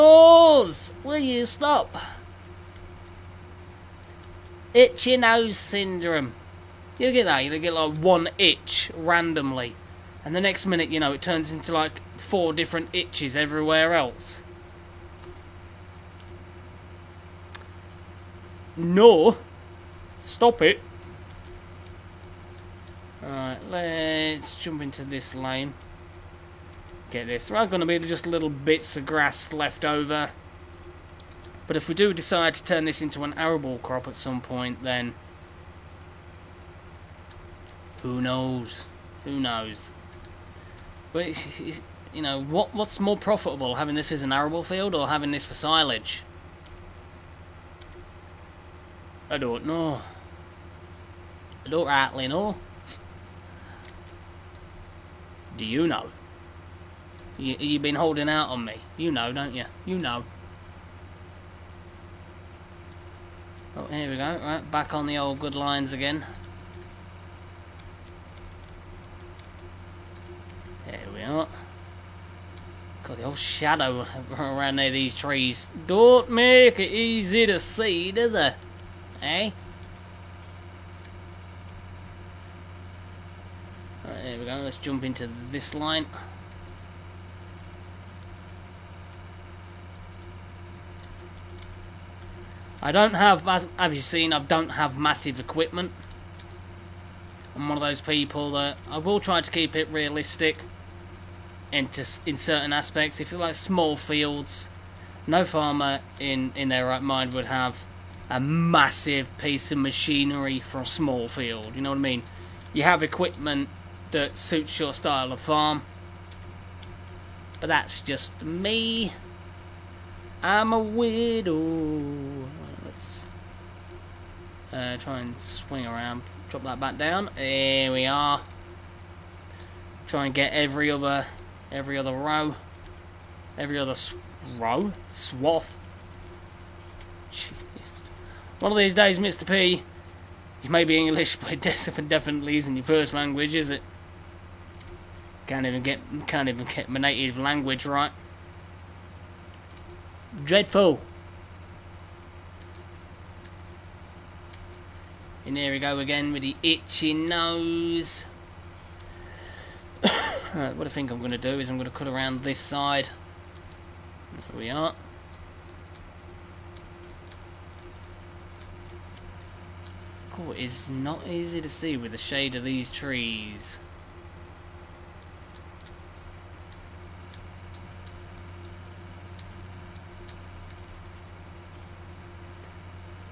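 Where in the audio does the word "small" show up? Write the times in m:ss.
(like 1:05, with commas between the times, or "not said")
1:43, 1:50.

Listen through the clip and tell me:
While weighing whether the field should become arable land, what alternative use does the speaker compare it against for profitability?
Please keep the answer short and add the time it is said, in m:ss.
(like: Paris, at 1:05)
silage, at 0:45.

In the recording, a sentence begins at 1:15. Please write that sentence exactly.
Don't make it easy to see, do they?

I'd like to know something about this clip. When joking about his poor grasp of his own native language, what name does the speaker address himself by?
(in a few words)
Mr. P.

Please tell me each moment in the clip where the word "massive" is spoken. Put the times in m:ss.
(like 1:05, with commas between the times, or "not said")
1:34, 1:48.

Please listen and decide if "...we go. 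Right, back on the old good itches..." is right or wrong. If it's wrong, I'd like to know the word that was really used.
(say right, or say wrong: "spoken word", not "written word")
wrong: "lines", not "itches".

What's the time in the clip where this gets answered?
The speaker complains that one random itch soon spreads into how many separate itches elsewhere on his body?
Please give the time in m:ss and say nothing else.
0:12.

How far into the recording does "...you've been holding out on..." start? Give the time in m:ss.
0:57.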